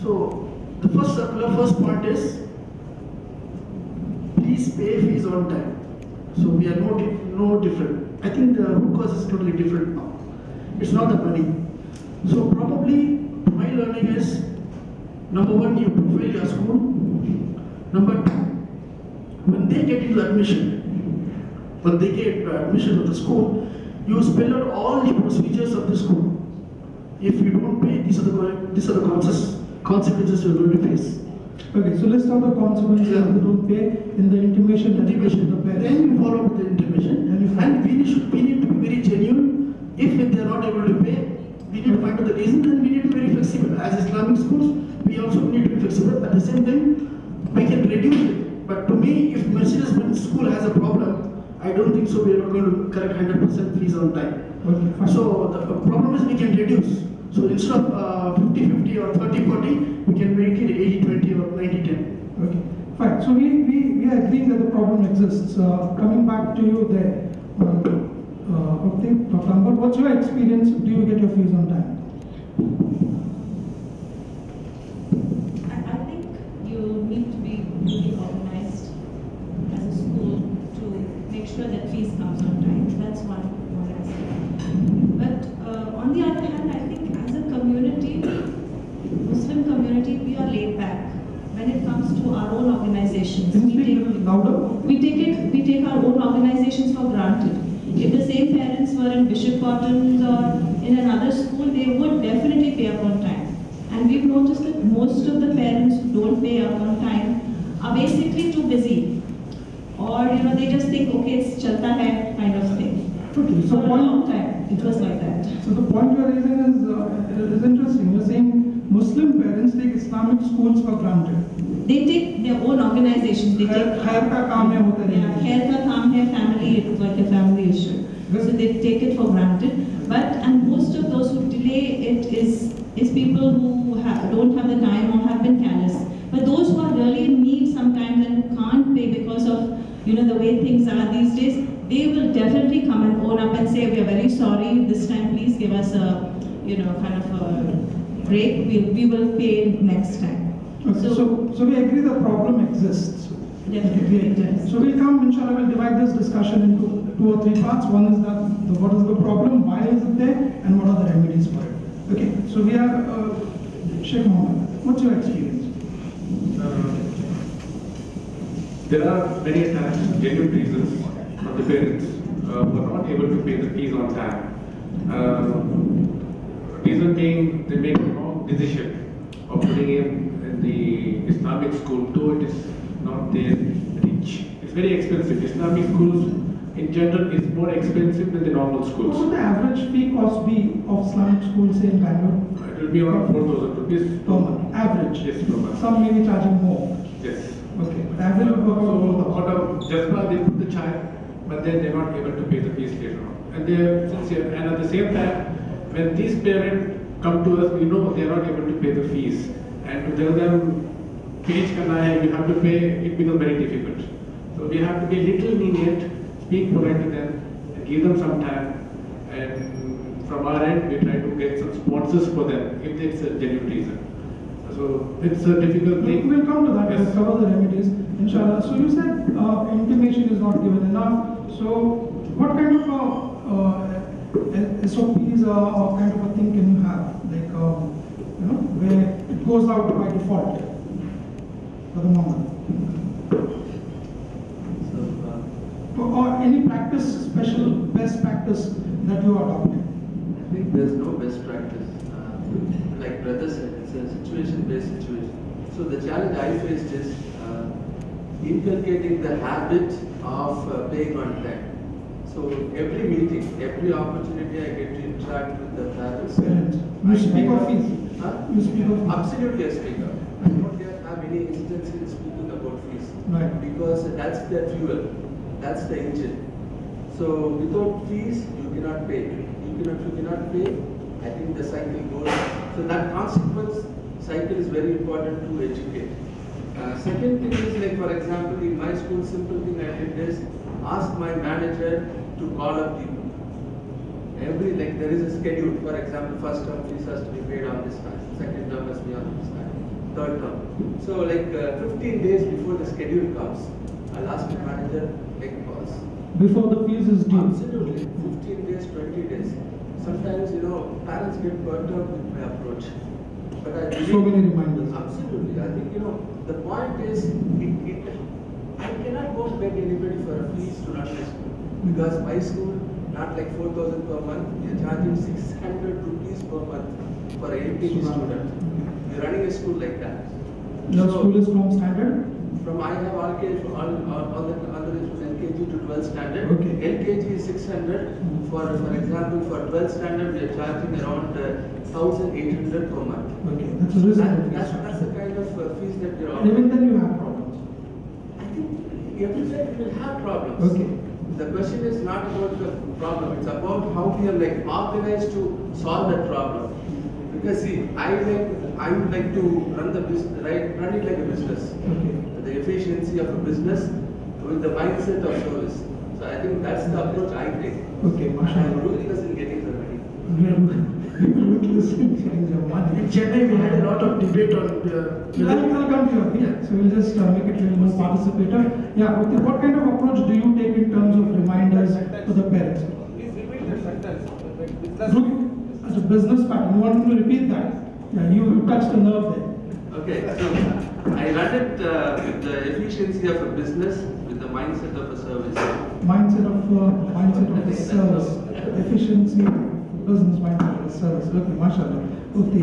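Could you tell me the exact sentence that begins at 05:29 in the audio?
You're running a school like that.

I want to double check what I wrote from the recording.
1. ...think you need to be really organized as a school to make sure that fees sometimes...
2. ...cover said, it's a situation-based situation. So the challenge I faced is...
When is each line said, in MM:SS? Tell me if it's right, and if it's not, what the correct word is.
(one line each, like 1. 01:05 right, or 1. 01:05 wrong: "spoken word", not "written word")
1. 01:16 wrong: "comes", not "sometimes"
2. 04:13 wrong: "brother", not "cover".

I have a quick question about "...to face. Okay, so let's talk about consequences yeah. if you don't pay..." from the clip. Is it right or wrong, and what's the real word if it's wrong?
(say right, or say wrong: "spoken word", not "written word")
right.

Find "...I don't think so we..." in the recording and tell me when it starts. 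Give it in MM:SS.
00:51.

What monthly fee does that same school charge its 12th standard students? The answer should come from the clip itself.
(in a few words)
1,800.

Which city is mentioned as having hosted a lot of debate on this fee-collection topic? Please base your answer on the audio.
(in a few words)
Chennai.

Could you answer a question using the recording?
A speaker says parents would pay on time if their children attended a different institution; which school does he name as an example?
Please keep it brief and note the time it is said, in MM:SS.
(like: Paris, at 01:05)
Bishop Cotton's, at 01:39.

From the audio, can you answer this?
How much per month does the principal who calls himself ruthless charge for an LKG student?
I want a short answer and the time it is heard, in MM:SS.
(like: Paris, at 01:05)
600 rupees, at 05:25.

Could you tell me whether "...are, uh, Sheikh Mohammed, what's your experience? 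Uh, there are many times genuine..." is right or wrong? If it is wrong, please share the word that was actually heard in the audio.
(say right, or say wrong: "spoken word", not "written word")
right.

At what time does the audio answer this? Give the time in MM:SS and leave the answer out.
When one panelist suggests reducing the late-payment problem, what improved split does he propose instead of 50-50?
01:01.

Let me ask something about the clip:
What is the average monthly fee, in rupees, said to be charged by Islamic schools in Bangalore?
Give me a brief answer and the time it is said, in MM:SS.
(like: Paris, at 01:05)
4,000, at 03:13.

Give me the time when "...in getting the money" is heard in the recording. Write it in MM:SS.
06:09.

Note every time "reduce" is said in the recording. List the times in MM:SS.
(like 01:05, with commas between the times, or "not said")
00:47, 00:56.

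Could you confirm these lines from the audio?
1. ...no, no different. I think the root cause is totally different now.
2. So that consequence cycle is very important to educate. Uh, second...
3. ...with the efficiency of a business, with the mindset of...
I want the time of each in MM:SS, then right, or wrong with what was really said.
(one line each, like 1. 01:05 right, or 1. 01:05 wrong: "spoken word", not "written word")
1. 00:06 right
2. 04:42 right
3. 06:32 right.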